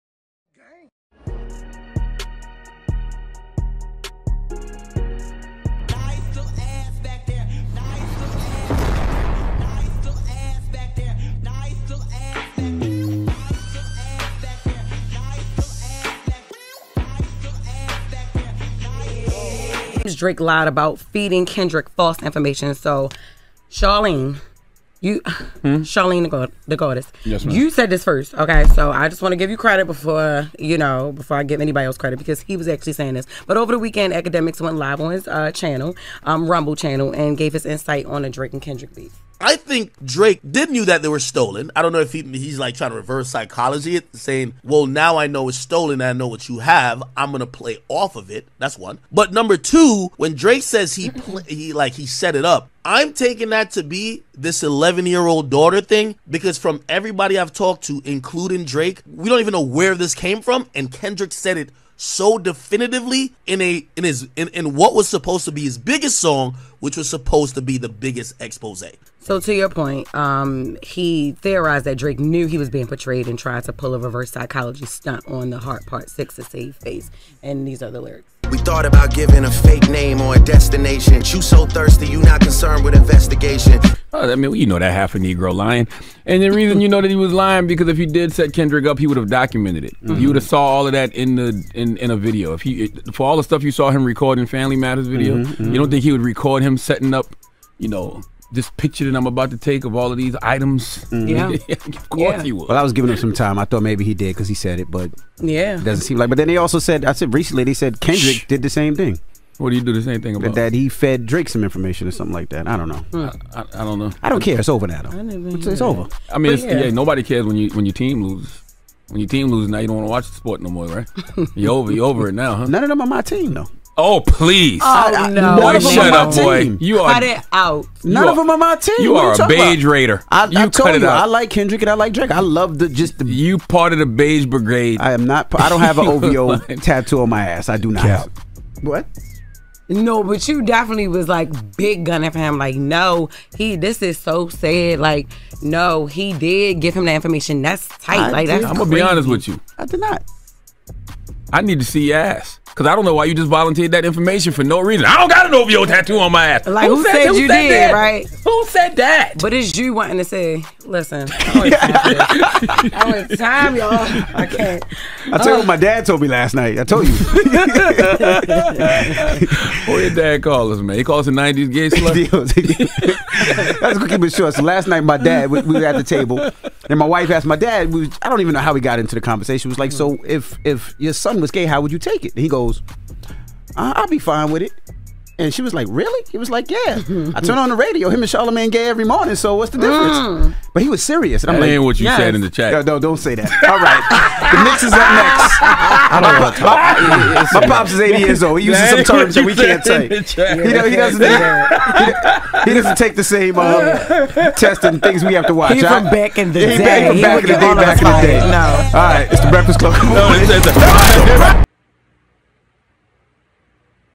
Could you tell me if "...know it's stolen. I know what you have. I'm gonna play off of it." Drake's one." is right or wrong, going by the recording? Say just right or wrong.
wrong.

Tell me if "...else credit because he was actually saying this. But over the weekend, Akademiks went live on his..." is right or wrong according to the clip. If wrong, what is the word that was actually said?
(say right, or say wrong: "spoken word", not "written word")
right.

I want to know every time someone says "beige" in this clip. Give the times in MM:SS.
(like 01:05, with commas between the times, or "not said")
02:09, 02:14.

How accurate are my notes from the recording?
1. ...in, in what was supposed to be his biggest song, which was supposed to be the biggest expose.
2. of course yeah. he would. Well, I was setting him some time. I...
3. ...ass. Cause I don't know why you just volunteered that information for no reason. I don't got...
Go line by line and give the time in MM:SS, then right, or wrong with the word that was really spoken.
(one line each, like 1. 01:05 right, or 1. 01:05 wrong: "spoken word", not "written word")
1. 01:04 right
2. 01:41 wrong: "giving", not "setting"
3. 02:32 right.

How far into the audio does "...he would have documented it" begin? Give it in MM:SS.
01:28.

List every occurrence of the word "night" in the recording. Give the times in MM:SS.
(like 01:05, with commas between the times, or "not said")
02:46, 02:54.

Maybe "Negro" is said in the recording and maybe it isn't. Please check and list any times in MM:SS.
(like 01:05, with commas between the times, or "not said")
01:25.